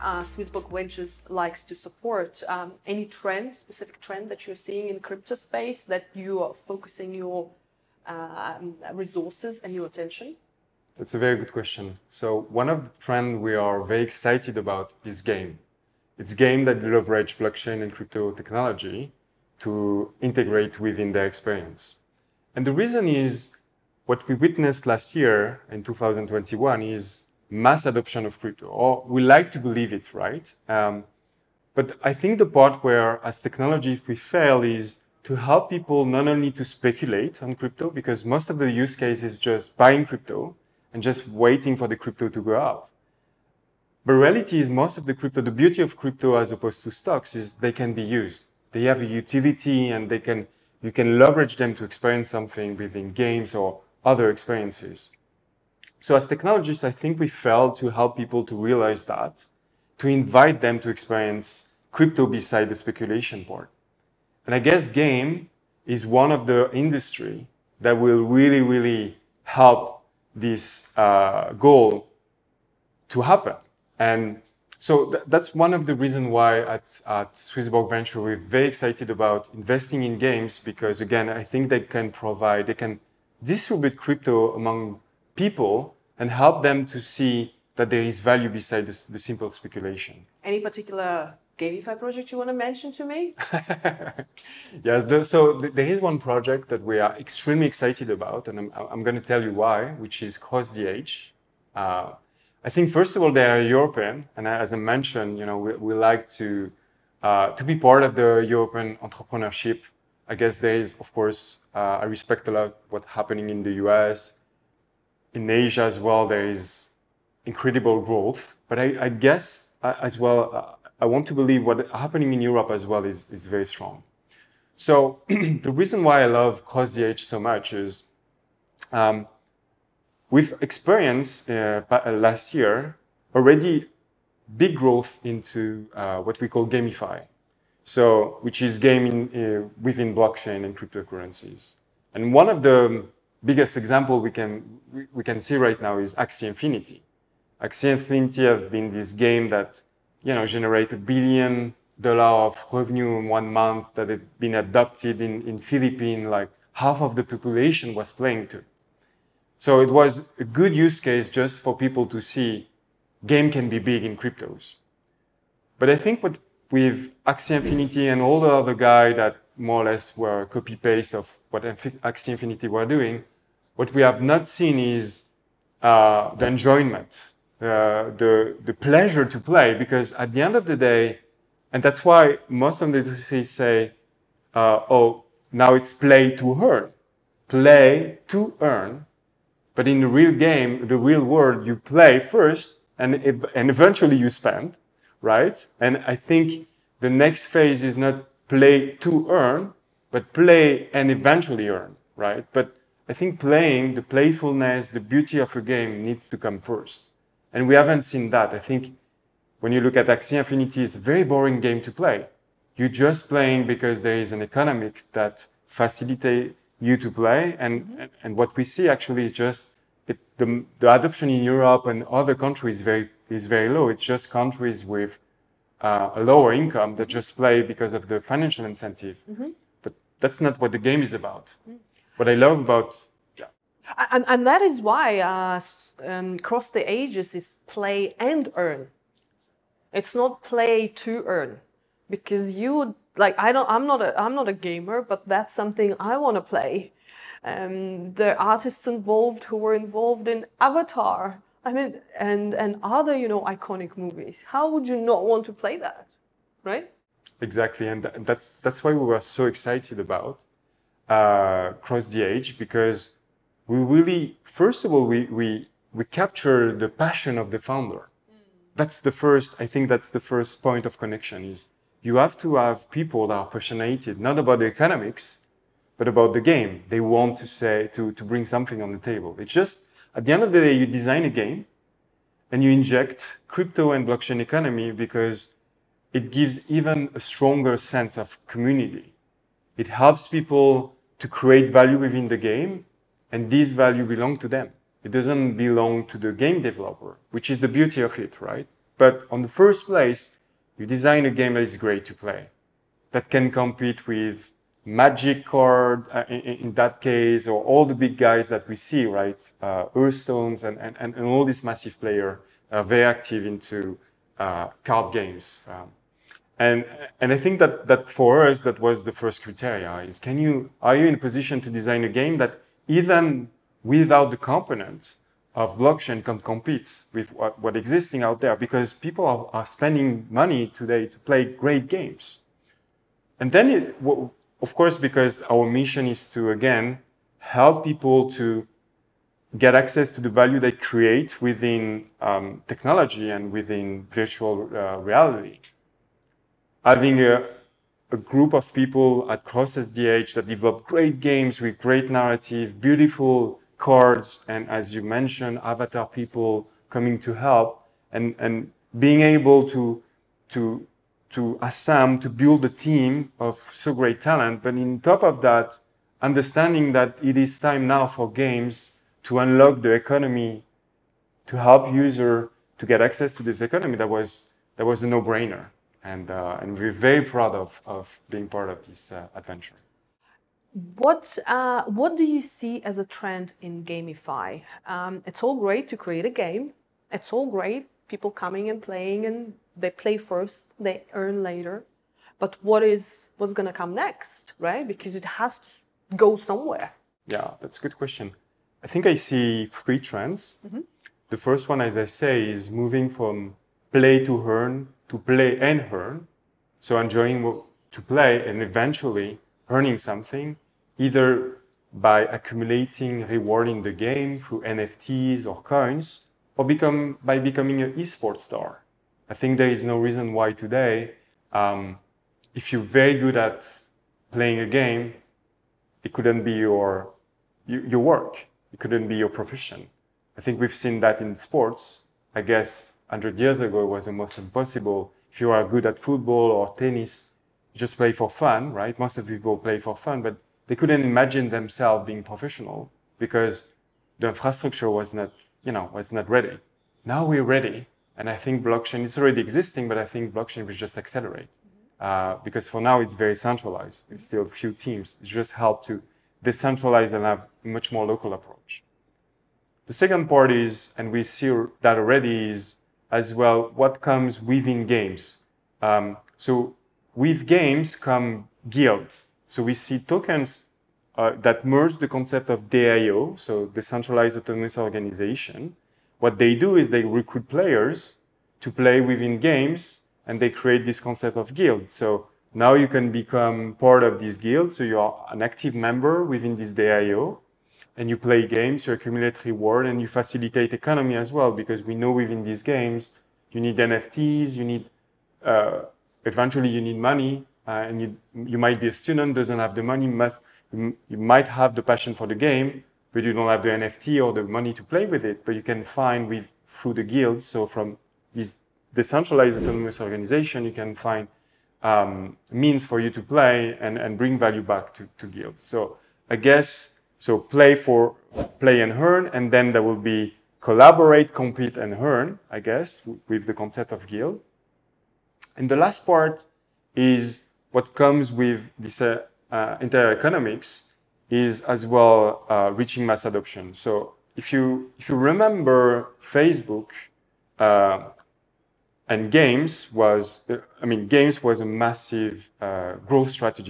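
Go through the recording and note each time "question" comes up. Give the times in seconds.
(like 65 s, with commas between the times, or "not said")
11 s, 397 s.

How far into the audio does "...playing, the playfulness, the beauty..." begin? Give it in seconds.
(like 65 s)
203 s.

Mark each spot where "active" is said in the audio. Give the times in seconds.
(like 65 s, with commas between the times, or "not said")
313 s, 485 s.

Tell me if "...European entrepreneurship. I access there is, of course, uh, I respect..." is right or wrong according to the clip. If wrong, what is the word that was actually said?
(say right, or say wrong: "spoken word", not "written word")
wrong: "guess", not "access".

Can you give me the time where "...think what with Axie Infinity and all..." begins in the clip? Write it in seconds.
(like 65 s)
165 s.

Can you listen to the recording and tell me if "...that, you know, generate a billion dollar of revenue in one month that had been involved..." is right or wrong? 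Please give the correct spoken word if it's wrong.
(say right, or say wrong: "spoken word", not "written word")
wrong: "adopted", not "involved".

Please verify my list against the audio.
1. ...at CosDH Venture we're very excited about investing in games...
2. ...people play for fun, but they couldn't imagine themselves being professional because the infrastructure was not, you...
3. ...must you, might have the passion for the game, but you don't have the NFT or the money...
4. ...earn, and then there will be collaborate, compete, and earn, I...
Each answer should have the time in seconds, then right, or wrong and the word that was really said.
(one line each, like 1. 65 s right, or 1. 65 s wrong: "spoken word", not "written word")
1. 77 s wrong: "Swissborg", not "CosDH"
2. 439 s right
3. 500 s right
4. 519 s right.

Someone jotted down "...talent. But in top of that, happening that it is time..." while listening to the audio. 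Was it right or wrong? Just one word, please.
wrong.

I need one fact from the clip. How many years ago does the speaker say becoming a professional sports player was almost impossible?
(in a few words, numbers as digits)
100.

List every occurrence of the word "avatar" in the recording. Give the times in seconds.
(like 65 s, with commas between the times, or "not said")
250 s, 355 s.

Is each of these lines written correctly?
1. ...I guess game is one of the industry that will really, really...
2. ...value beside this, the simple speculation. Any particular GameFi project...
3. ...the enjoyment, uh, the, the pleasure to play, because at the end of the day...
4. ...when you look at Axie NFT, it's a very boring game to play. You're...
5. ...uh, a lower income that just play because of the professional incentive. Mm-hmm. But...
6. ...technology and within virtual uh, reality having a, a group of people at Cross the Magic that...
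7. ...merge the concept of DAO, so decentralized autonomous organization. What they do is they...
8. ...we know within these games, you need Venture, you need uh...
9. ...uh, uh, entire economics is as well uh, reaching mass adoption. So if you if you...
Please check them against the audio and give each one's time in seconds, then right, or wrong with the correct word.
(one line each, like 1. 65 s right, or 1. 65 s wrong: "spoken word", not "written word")
1. 64 s right
2. 88 s right
3. 176 s right
4. 209 s wrong: "Infinity", not "NFT"
5. 225 s wrong: "financial", not "professional"
6. 342 s wrong: "Ages", not "Magic"
7. 471 s right
8. 491 s wrong: "NFTs", not "Venture"
9. 529 s right.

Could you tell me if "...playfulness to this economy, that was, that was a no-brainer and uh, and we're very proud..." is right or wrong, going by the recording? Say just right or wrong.
wrong.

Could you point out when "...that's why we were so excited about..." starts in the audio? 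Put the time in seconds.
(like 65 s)
258 s.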